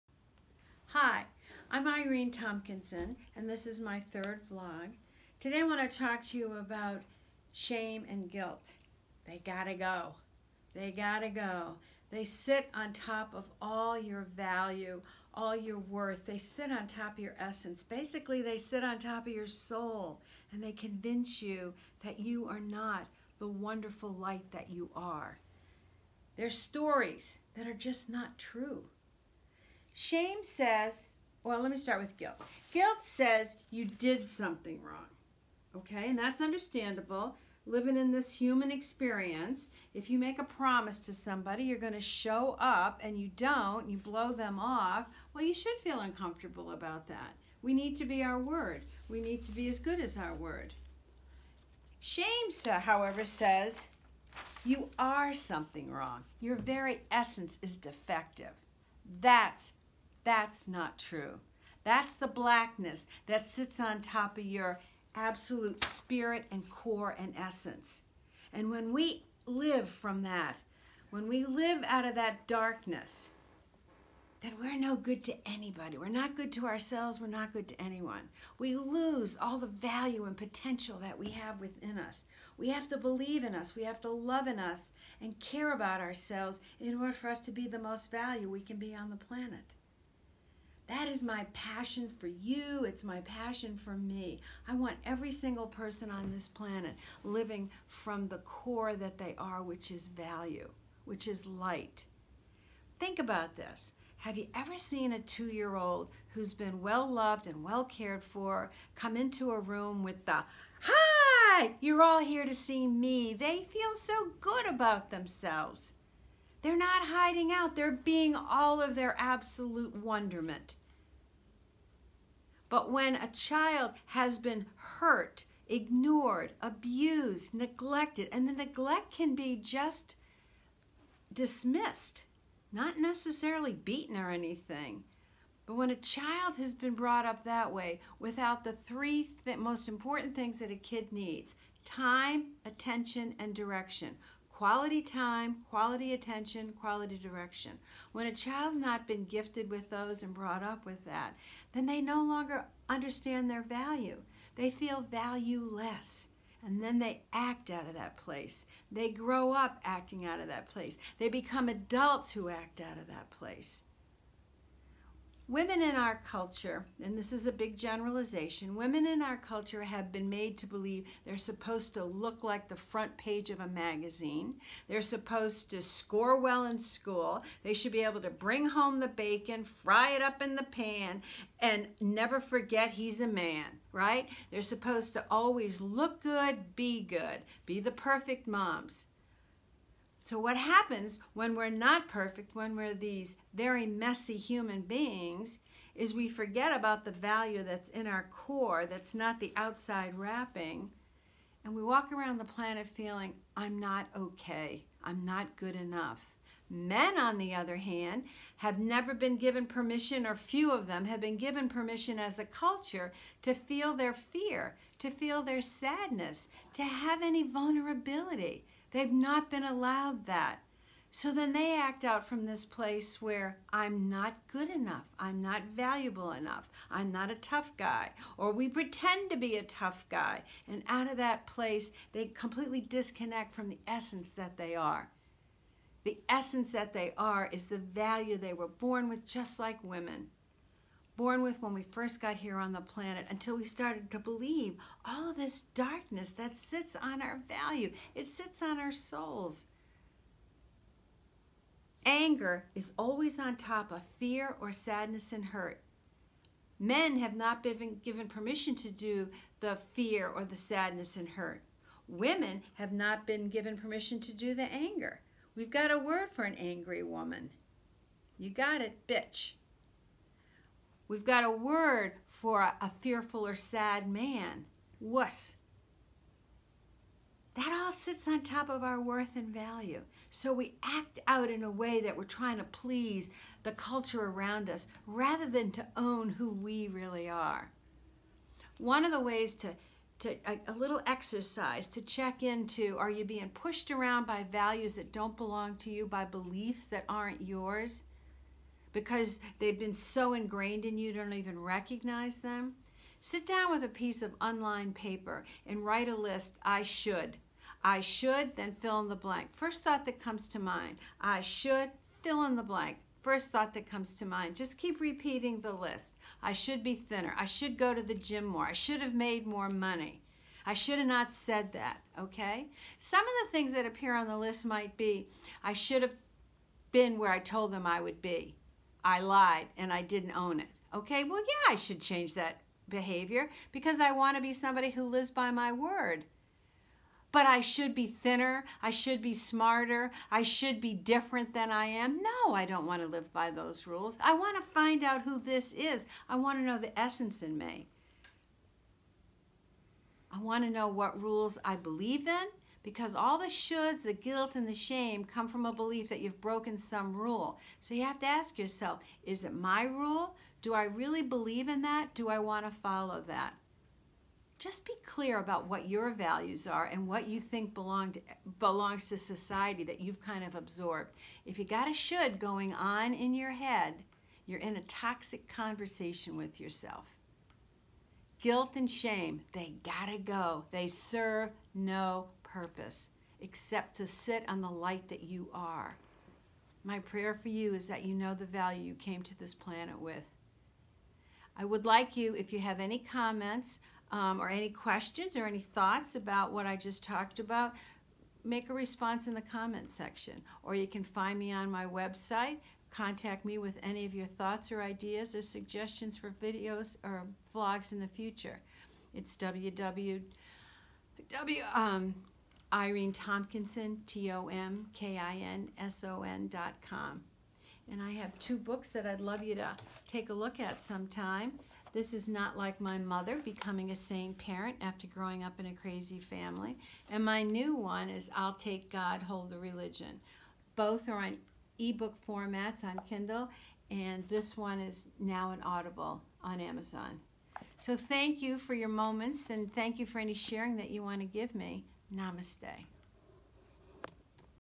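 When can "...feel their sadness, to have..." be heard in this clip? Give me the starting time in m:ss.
3:35.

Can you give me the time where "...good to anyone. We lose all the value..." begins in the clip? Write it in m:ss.
1:17.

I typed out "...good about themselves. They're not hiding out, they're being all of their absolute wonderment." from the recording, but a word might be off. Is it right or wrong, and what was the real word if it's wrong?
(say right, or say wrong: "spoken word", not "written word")
right.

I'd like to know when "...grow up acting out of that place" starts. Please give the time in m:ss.
2:39.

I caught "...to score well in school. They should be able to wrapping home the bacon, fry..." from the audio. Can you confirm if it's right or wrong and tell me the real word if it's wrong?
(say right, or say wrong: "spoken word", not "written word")
wrong: "bring", not "wrapping".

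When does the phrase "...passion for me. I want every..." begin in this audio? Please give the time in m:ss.
1:33.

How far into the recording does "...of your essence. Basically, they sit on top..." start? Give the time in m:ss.
0:17.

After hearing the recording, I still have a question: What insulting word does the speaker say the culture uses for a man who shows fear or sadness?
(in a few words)
wuss.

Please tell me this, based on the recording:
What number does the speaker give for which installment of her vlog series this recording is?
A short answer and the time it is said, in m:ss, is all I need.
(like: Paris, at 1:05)
third, at 0:04.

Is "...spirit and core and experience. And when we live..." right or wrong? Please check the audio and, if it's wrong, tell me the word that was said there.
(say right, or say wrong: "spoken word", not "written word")
wrong: "essence", not "experience".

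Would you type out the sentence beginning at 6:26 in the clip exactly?
My prayer for you is that you know the value you came to this planet with.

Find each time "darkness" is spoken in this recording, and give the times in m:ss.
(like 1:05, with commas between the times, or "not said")
1:12, 4:05.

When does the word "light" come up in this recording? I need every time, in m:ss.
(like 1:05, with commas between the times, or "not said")
0:24, 1:41, 6:24.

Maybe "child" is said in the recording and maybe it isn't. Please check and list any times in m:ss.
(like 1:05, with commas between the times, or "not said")
2:03, 2:15, 2:28.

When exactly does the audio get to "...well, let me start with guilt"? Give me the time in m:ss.
0:31.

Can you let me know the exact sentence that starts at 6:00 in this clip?
Do I really believe in that?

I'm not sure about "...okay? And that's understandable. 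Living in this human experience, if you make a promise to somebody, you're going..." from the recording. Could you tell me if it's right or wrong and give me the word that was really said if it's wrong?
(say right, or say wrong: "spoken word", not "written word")
right.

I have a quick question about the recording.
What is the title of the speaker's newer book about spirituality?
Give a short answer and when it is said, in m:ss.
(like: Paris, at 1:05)
I'll Take God, Hold the Religion, at 7:08.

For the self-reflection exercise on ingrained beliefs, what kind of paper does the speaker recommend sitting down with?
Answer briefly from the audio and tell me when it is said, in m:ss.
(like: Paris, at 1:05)
unlined paper, at 5:04.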